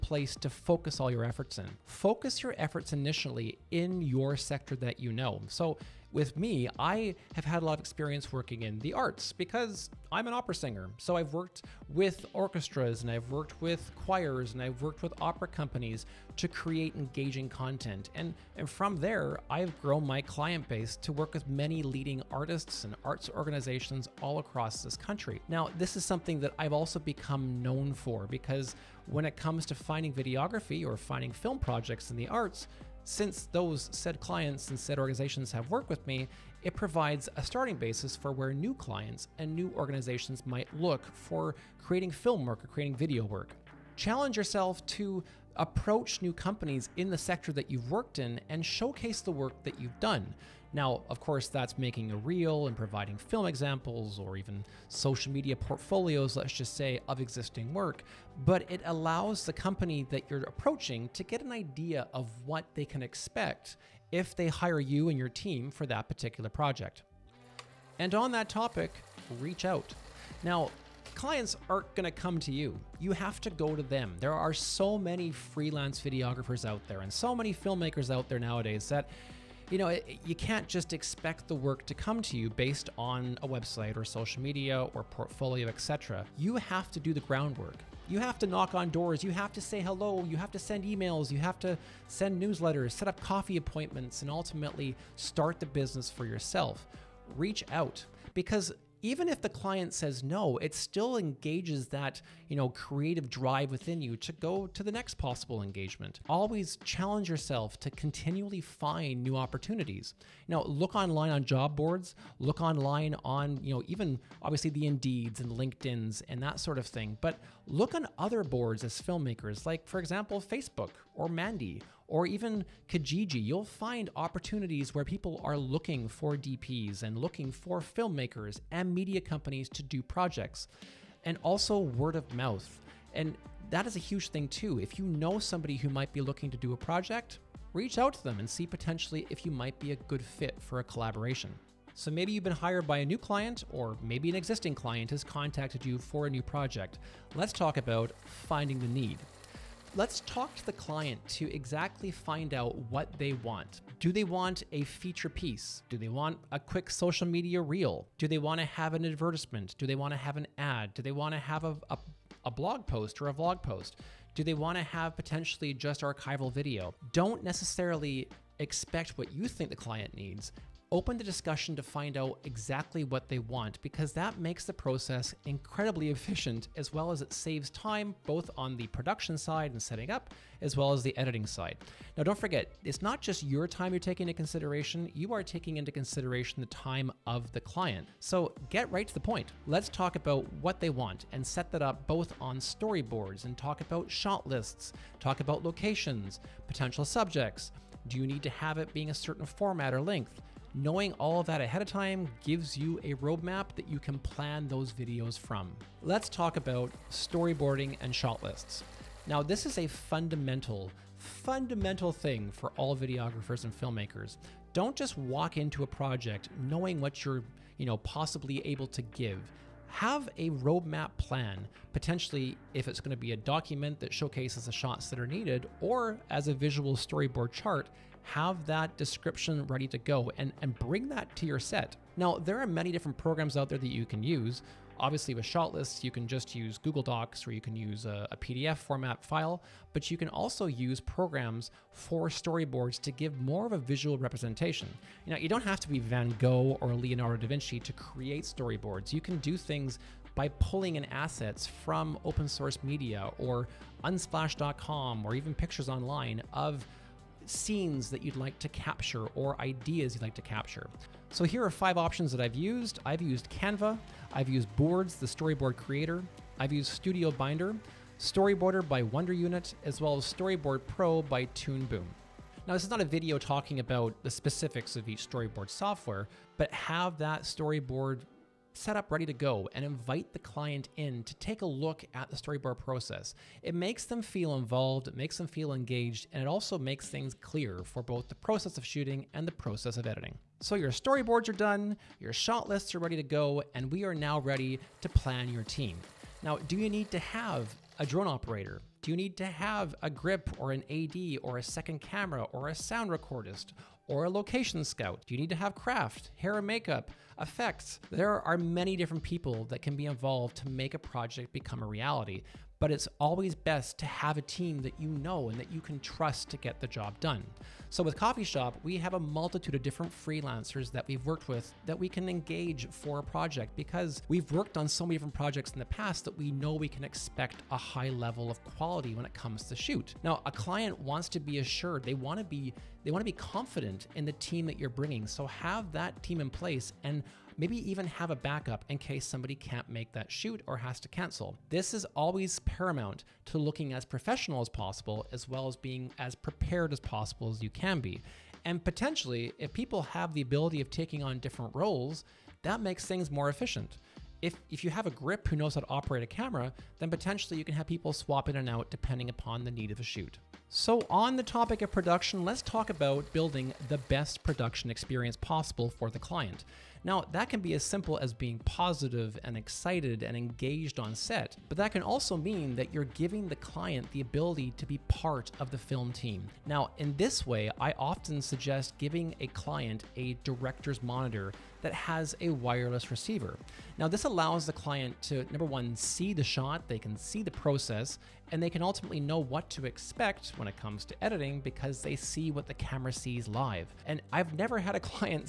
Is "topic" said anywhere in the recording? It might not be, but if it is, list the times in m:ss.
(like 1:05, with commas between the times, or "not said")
1:08, 6:01.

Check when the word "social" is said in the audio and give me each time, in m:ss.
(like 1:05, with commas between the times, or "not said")
0:54, 1:24, 2:36.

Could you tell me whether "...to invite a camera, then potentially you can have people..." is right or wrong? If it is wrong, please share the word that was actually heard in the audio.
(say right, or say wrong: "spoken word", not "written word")
wrong: "operate", not "invite".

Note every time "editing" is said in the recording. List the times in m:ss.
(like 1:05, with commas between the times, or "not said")
3:01, 4:50, 6:31.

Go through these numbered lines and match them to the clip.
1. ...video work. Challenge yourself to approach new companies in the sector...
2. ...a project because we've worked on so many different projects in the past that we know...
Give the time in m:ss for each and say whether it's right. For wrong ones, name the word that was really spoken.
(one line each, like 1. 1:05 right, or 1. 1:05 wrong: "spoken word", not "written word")
1. 0:42 right
2. 5:23 right.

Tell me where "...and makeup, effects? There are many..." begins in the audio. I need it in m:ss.
5:06.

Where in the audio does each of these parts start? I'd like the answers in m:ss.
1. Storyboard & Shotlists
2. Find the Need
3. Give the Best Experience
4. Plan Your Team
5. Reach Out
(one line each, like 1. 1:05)
1. 3:26
2. 2:28
3. 6:01
4. 4:55
5. 1:07.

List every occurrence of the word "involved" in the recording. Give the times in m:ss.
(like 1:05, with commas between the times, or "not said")
4:44, 5:10.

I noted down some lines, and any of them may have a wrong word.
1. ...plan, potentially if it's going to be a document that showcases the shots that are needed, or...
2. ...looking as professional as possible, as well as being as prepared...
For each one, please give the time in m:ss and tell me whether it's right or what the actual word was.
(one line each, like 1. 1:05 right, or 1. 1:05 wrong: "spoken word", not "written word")
1. 3:41 right
2. 5:43 right.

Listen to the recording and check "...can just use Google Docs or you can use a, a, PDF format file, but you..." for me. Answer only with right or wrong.
right.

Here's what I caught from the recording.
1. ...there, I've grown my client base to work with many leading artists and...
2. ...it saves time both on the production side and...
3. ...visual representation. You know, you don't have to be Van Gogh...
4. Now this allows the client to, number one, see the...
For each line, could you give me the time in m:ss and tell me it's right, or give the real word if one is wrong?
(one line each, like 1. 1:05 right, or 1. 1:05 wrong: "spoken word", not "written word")
1. 0:18 right
2. 2:57 right
3. 4:03 right
4. 6:23 right.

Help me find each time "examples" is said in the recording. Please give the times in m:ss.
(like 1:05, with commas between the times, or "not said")
0:53, 2:00.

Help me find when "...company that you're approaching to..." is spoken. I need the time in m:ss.
0:59.